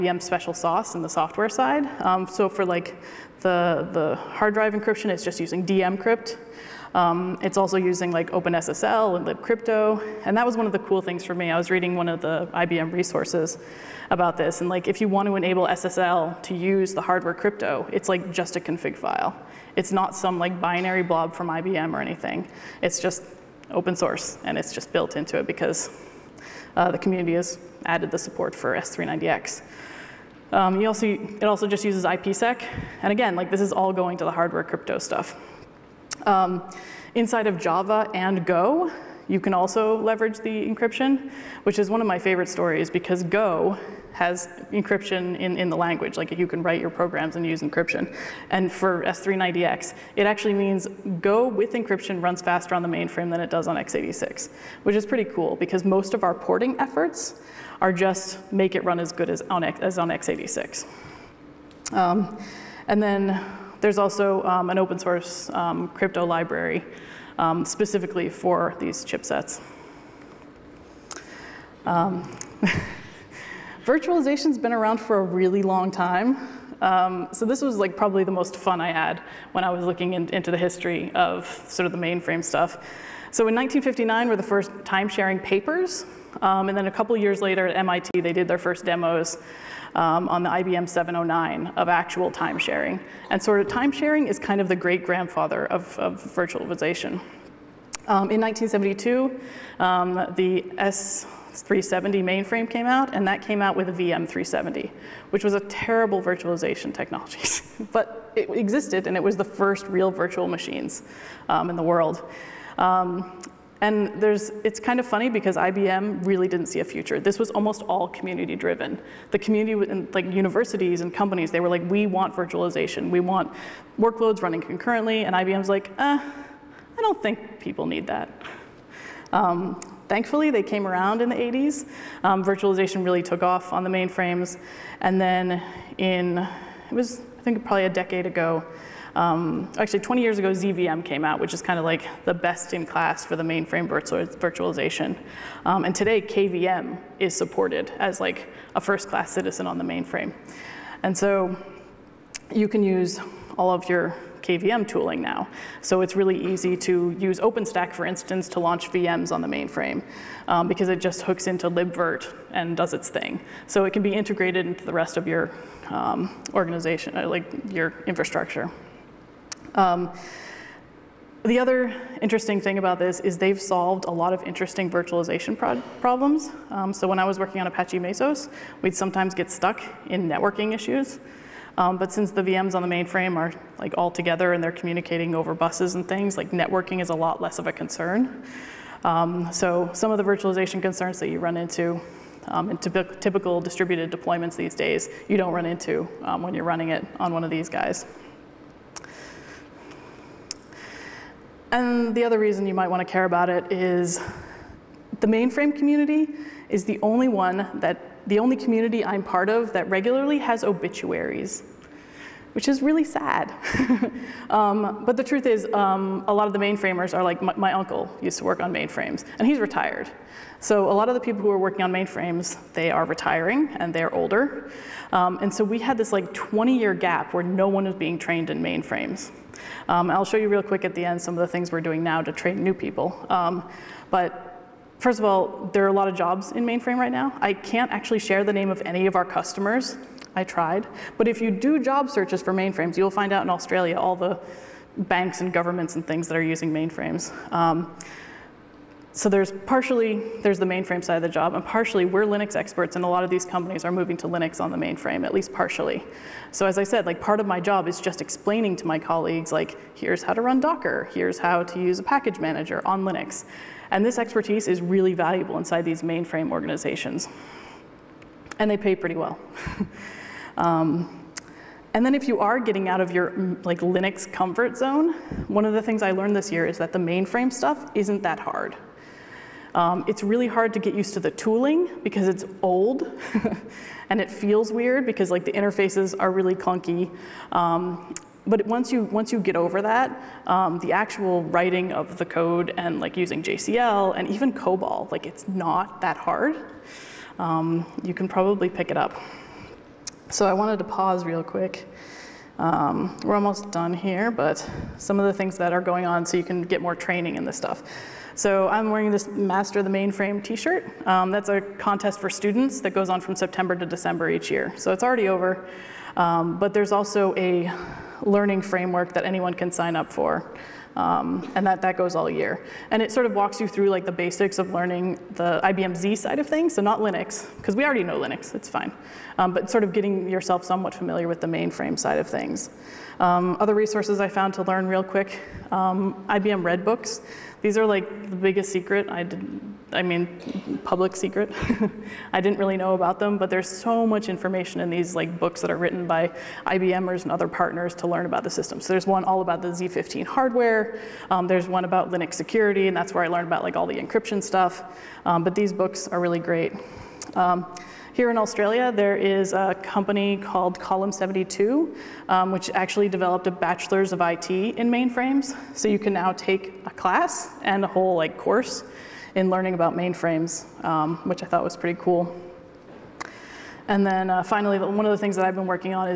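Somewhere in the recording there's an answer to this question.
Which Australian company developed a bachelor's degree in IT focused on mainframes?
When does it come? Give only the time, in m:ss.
6:00.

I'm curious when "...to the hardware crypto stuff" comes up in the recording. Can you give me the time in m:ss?
0:34.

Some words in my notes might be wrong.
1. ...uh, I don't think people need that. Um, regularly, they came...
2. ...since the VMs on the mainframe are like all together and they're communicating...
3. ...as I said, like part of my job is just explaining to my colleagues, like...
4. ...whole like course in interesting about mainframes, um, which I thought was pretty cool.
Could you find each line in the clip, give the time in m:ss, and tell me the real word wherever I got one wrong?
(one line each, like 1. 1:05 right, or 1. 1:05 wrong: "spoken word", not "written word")
1. 2:05 wrong: "thankfully", not "regularly"
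2. 3:02 right
3. 4:16 right
4. 6:07 wrong: "learning", not "interesting".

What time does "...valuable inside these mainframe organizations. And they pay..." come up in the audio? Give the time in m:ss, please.
4:25.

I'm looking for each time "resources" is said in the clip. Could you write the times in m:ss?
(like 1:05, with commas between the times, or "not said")
0:12, 5:33.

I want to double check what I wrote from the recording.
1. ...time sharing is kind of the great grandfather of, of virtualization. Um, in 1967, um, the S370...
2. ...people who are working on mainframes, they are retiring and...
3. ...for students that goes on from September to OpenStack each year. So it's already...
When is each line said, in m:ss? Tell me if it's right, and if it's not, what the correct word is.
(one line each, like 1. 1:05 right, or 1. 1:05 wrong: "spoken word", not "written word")
1. 1:33 wrong: "1972", not "1967"
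2. 3:41 right
3. 5:12 wrong: "December", not "OpenStack".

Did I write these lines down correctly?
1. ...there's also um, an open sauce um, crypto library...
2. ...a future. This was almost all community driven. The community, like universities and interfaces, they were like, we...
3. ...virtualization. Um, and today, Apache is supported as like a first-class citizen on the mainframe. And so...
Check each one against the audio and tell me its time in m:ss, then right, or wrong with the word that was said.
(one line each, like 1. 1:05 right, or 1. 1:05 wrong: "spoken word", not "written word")
1. 1:03 wrong: "source", not "sauce"
2. 1:56 wrong: "companies", not "interfaces"
3. 2:23 wrong: "KVM", not "Apache".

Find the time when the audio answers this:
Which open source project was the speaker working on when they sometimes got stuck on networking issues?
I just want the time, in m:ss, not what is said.
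2:57.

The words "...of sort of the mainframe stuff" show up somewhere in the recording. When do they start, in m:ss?
1:21.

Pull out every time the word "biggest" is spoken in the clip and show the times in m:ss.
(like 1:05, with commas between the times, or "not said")
5:38.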